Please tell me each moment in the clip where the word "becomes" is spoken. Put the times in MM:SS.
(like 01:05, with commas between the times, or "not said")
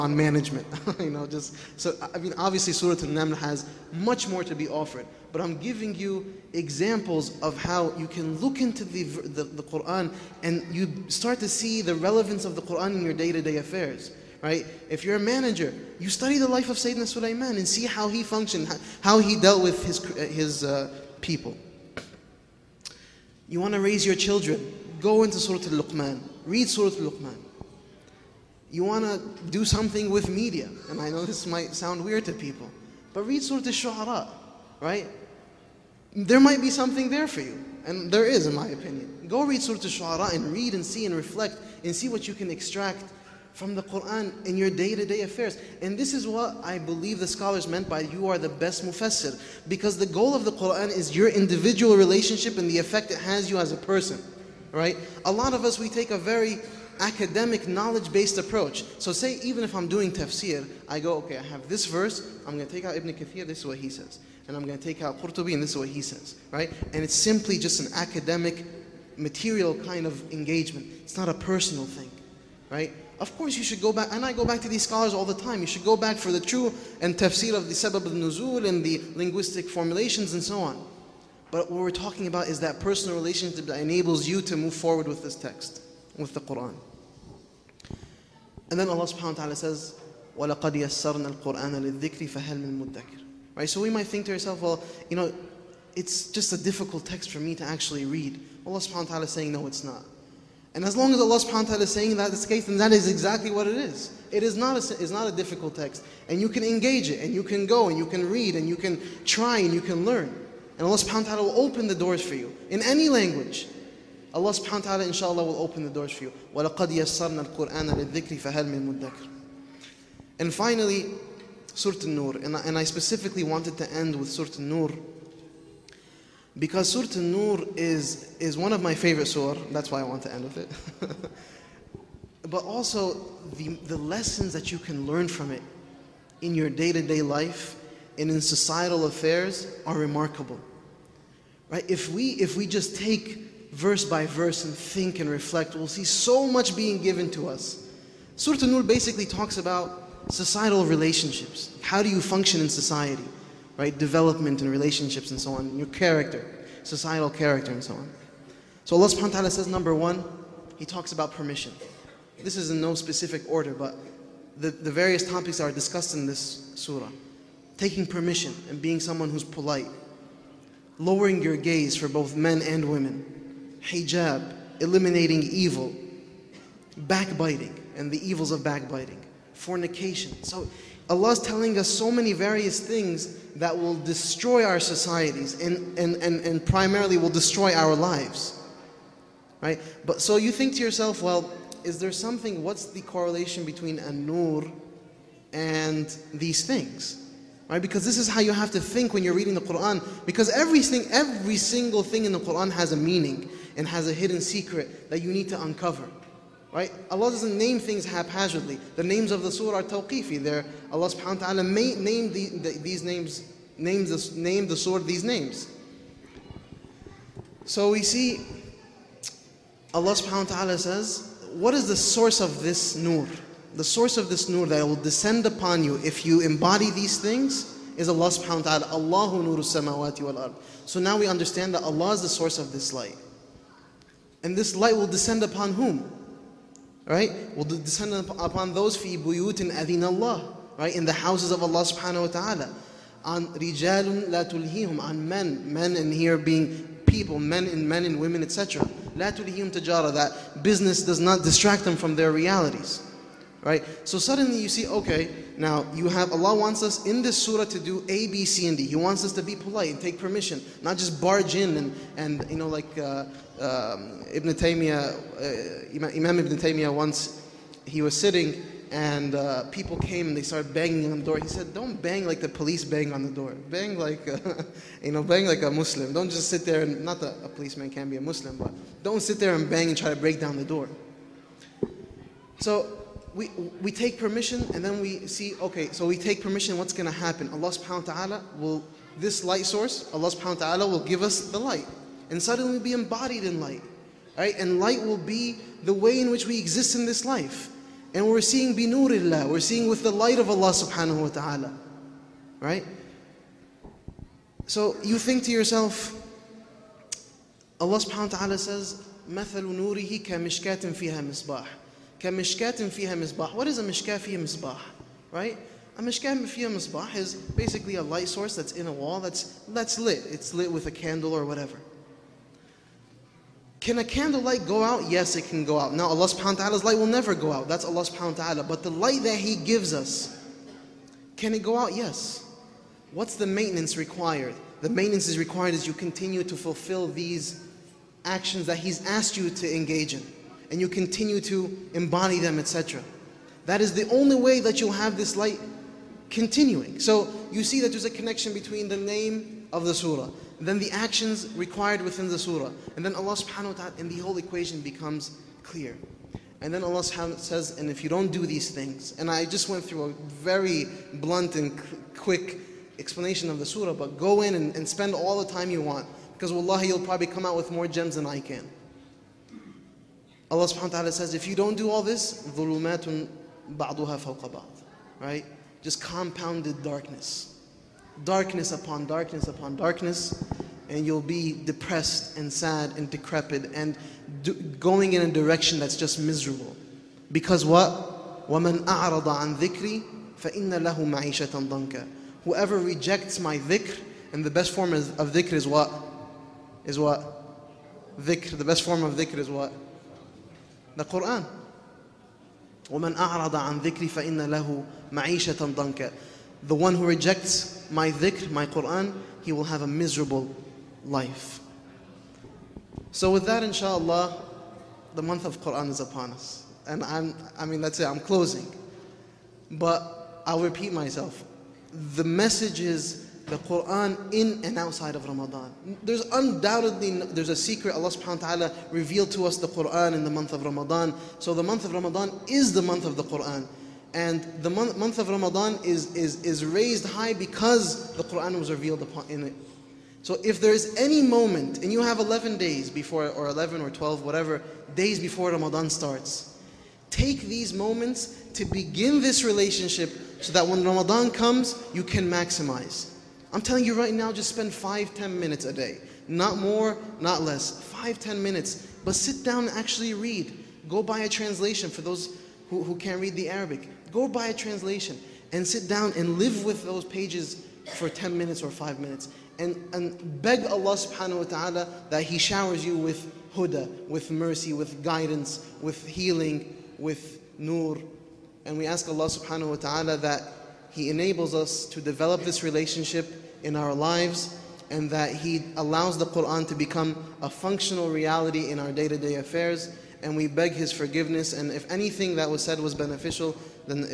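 05:54, 08:06.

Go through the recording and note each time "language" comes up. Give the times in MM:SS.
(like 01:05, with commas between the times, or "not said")
01:53.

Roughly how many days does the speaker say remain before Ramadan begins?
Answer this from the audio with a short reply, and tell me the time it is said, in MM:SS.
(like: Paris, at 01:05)
11, at 07:22.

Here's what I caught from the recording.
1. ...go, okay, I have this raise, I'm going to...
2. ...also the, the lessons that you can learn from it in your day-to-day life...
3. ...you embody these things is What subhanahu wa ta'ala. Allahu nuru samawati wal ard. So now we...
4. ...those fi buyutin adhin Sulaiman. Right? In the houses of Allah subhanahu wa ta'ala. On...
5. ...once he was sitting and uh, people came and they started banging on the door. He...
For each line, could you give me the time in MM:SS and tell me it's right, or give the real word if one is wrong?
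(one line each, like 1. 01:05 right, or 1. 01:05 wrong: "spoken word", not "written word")
1. 01:00 wrong: "verse", not "raise"
2. 02:12 right
3. 03:46 wrong: "Allah", not "What"
4. 03:58 wrong: "Allah", not "Sulaiman"
5. 04:26 right.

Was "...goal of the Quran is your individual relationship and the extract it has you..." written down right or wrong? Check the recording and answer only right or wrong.
wrong.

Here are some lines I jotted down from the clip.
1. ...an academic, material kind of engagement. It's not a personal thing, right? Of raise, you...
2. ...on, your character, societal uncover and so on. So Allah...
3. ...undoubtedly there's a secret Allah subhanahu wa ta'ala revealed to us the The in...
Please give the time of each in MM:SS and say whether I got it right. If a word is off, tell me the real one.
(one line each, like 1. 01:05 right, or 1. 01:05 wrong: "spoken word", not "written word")
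1. 01:07 wrong: "course", not "raise"
2. 02:35 wrong: "character", not "uncover"
3. 07:06 wrong: "Quran", not "The".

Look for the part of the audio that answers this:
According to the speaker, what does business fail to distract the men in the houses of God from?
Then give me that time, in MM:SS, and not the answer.
04:12.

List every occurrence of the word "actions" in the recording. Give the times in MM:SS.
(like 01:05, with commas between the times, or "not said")
05:38, 05:50.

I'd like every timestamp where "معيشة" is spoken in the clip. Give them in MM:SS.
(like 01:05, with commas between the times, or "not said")
06:30, 06:45.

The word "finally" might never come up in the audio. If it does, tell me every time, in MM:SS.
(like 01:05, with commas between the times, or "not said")
02:00.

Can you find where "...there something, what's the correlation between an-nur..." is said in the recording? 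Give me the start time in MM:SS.
03:11.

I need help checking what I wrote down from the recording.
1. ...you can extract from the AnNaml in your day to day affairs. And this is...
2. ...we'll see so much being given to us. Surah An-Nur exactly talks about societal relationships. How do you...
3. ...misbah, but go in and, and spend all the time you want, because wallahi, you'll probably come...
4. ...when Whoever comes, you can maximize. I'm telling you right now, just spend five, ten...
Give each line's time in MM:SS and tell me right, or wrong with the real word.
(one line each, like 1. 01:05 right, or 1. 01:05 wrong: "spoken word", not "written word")
1. 00:42 wrong: "Quran", not "AnNaml"
2. 02:25 wrong: "basically", not "exactly"
3. 06:03 wrong: "surah", not "misbah"
4. 07:30 wrong: "Ramadan", not "Whoever".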